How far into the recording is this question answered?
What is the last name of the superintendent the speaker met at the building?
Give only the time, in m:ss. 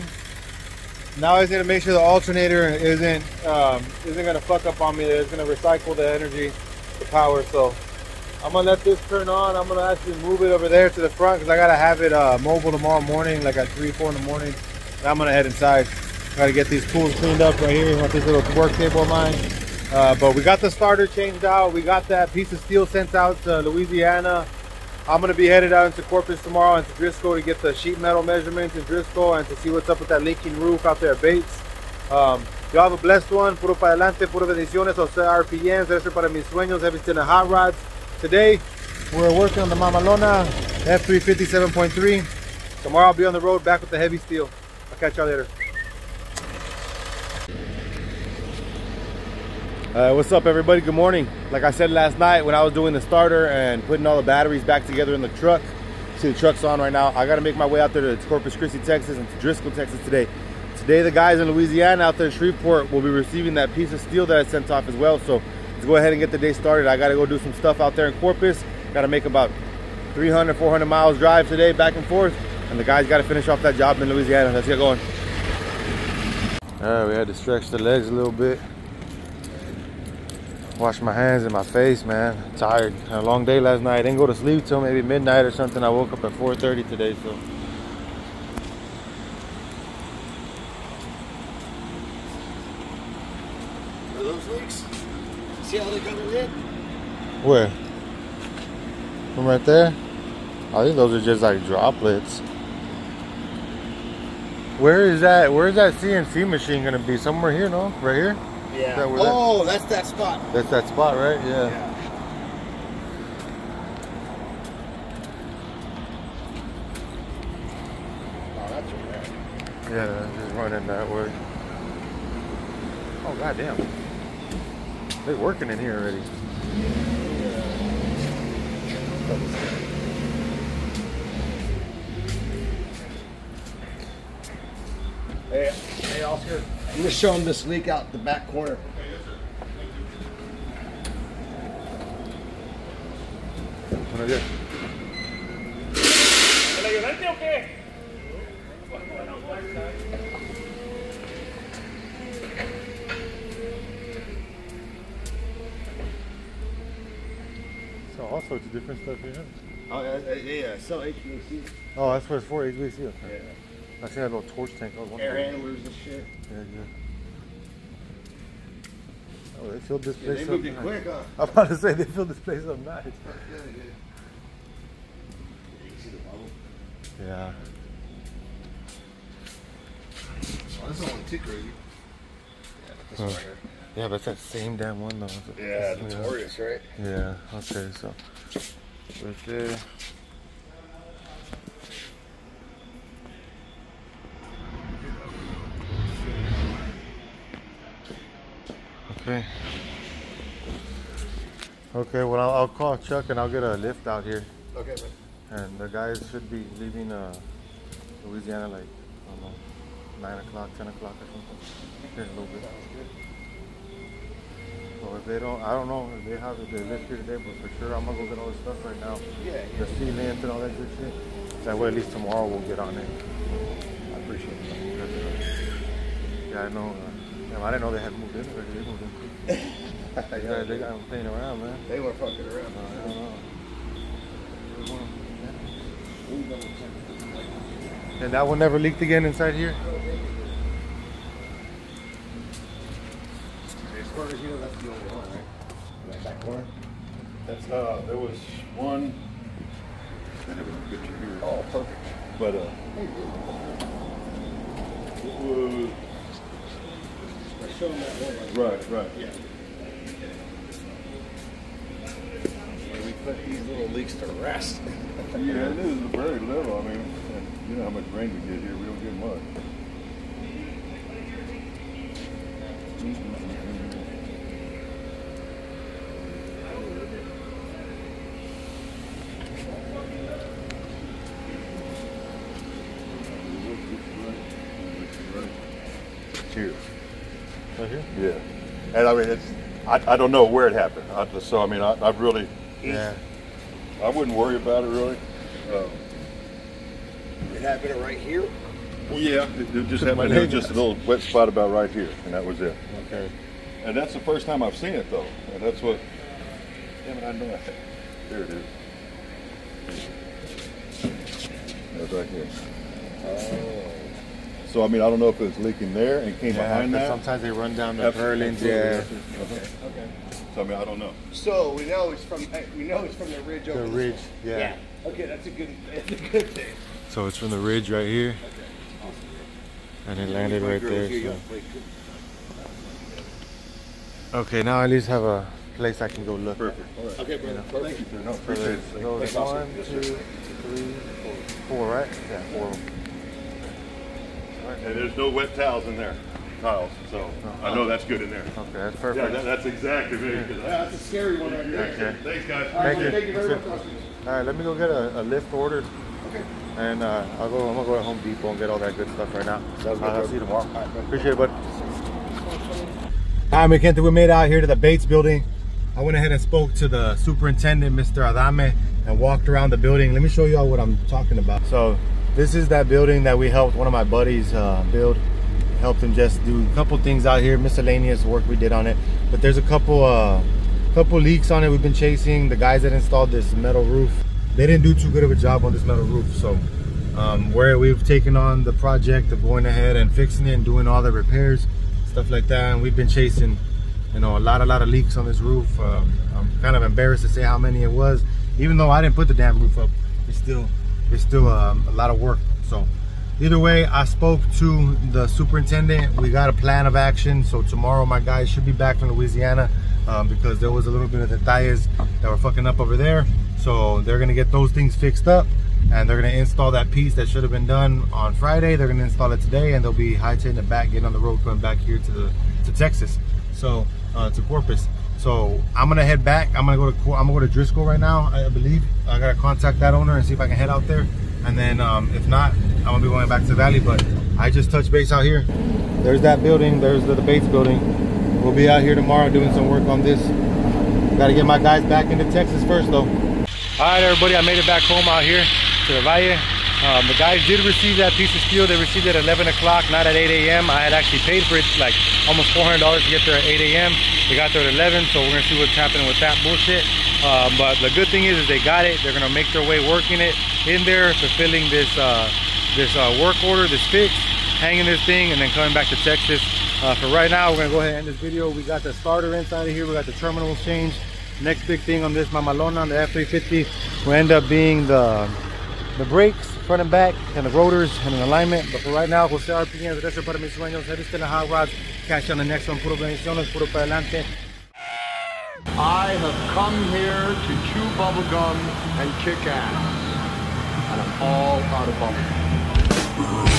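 6:08.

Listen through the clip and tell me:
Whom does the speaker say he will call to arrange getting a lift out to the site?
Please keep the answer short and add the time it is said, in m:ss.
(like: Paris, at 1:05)
Chuck, at 3:22.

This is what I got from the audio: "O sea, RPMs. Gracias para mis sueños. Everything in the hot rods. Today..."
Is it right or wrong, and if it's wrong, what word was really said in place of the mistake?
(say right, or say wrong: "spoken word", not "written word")
right.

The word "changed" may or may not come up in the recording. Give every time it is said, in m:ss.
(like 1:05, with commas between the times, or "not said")
0:21, 7:50.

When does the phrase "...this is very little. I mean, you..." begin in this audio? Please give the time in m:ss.
4:25.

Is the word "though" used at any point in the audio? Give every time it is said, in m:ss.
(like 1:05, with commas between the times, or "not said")
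3:05, 5:05, 6:38, 7:22.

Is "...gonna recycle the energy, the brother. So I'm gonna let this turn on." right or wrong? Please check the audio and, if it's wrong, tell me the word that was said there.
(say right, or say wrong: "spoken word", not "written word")
wrong: "power", not "brother".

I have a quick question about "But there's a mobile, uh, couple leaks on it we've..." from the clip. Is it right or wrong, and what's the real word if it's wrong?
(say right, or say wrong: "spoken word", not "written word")
wrong: "couple", not "mobile".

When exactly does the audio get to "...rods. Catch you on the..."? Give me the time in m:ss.
8:01.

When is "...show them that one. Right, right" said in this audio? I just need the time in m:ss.
4:17.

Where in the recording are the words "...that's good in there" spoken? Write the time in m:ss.
5:47.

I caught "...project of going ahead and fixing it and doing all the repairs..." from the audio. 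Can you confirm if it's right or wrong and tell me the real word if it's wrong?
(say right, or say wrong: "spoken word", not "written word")
right.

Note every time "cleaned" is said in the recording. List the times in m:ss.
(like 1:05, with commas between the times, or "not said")
0:17.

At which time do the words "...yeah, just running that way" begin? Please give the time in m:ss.
1:59.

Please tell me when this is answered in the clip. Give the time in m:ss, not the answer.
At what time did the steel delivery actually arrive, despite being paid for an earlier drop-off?
7:29.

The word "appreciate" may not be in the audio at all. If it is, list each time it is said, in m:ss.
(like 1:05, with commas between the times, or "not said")
3:44, 5:38, 6:01.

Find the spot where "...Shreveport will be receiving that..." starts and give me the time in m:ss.
1:02.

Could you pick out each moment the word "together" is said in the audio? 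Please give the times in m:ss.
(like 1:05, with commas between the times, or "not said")
0:54.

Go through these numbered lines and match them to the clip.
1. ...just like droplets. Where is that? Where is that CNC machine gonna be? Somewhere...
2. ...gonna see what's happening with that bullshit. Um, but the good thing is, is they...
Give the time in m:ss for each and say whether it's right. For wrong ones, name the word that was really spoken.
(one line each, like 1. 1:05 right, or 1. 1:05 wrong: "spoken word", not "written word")
1. 1:41 right
2. 7:35 right.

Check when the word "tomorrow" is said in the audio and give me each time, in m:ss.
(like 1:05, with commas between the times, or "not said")
0:12, 0:26, 0:42, 3:42, 6:00, 6:47, 7:18.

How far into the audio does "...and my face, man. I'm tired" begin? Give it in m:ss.
1:21.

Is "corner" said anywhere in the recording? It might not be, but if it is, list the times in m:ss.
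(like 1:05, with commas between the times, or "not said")
2:18, 4:06.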